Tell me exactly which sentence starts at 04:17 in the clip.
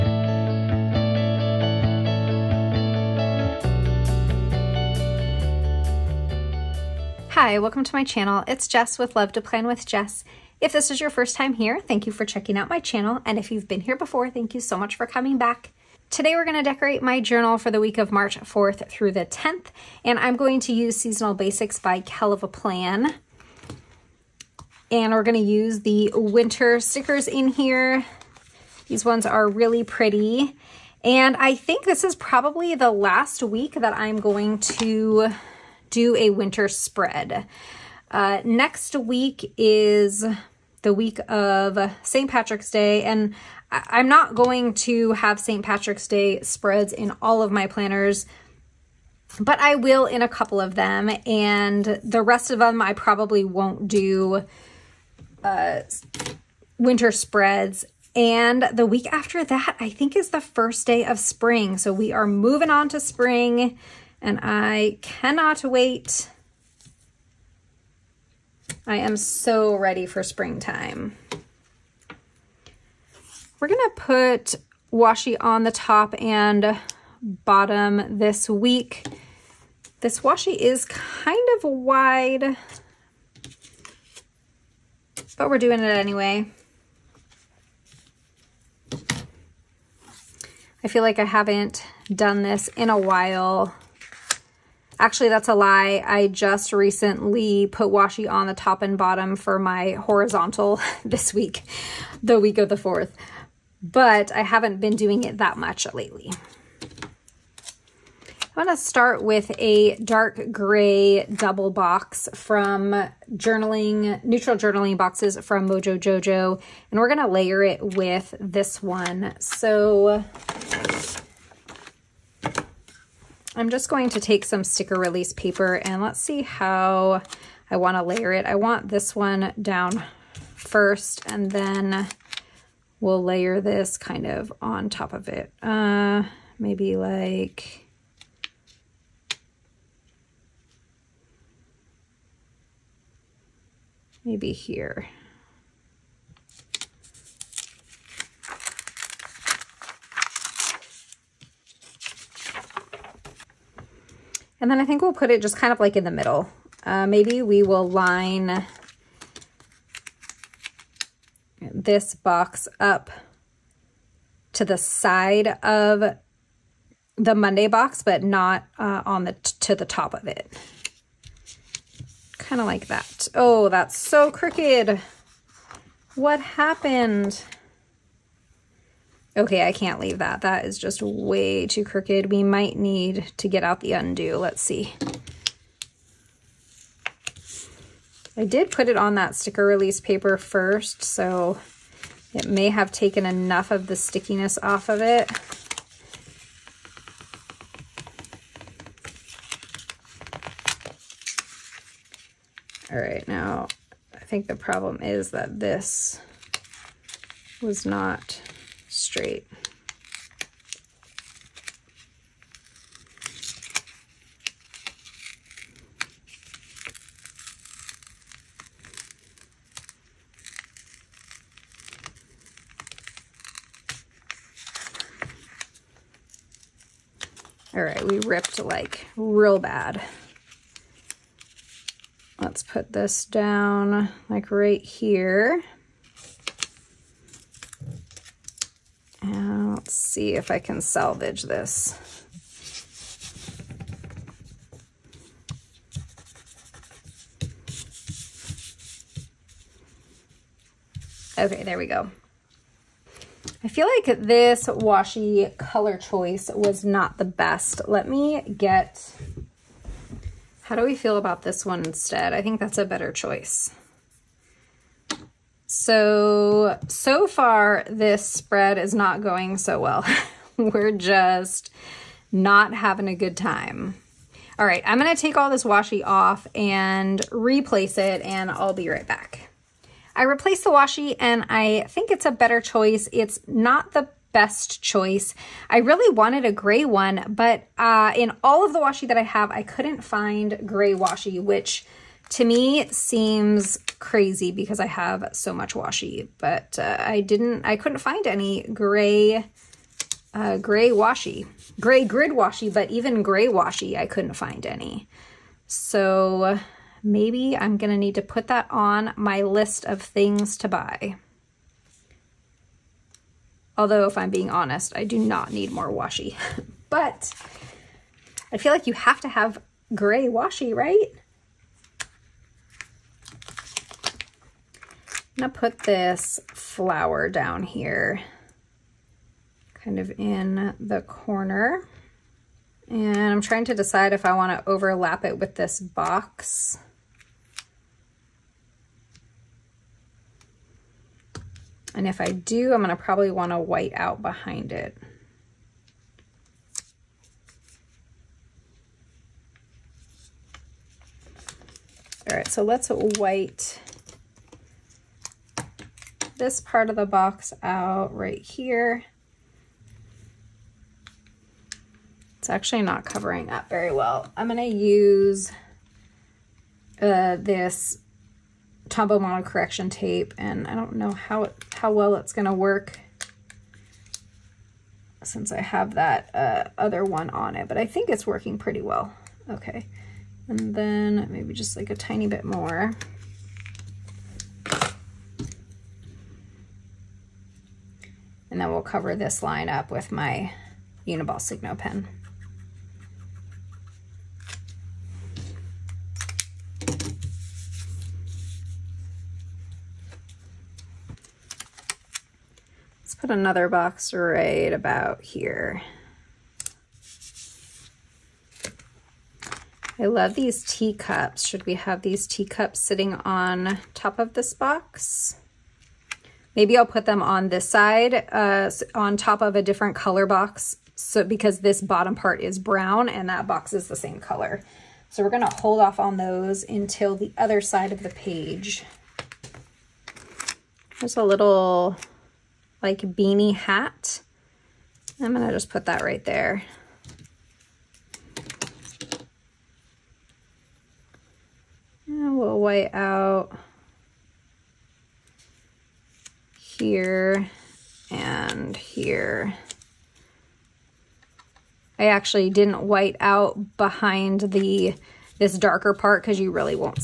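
Let me get, how do we feel about this one instead?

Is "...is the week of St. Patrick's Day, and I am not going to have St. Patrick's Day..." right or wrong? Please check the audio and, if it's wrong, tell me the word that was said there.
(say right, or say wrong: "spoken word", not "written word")
right.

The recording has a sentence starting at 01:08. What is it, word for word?
I am so ready for springtime.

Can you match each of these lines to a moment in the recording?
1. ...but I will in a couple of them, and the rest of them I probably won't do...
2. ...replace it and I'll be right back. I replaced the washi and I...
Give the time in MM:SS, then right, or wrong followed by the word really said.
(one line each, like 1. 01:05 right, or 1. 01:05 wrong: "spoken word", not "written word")
1. 00:49 right
2. 04:37 right.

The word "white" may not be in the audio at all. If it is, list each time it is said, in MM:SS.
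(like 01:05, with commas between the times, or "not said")
05:43, 05:52, 07:22, 07:32.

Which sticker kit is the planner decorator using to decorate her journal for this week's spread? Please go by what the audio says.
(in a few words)
Seasonal Basics.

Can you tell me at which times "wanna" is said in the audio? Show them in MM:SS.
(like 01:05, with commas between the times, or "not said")
05:34, 05:43.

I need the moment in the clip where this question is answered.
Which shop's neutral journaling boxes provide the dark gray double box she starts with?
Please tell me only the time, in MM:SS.
01:55.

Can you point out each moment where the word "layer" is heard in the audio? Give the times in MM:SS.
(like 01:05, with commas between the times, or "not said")
01:57, 02:08, 02:13.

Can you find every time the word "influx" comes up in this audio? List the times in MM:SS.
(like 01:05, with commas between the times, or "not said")
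not said.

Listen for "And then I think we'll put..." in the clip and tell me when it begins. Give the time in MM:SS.
02:34.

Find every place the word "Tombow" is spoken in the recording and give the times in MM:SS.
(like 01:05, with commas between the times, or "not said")
06:08.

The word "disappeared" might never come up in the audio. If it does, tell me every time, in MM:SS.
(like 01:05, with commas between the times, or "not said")
not said.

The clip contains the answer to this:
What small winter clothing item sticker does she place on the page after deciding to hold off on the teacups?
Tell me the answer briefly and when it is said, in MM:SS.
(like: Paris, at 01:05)
Beanie hat, at 07:12.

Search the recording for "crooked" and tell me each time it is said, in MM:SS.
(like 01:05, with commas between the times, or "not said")
02:54, 03:01.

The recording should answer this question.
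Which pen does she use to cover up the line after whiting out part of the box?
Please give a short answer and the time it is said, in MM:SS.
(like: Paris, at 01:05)
Uniball Signo, at 06:31.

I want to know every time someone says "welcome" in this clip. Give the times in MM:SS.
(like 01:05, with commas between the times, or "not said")
00:07.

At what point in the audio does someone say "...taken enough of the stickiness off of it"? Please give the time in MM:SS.
03:12.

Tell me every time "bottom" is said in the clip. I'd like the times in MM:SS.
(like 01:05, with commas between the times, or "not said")
01:17, 01:38, 07:01.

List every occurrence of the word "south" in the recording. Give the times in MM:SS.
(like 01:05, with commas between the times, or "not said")
not said.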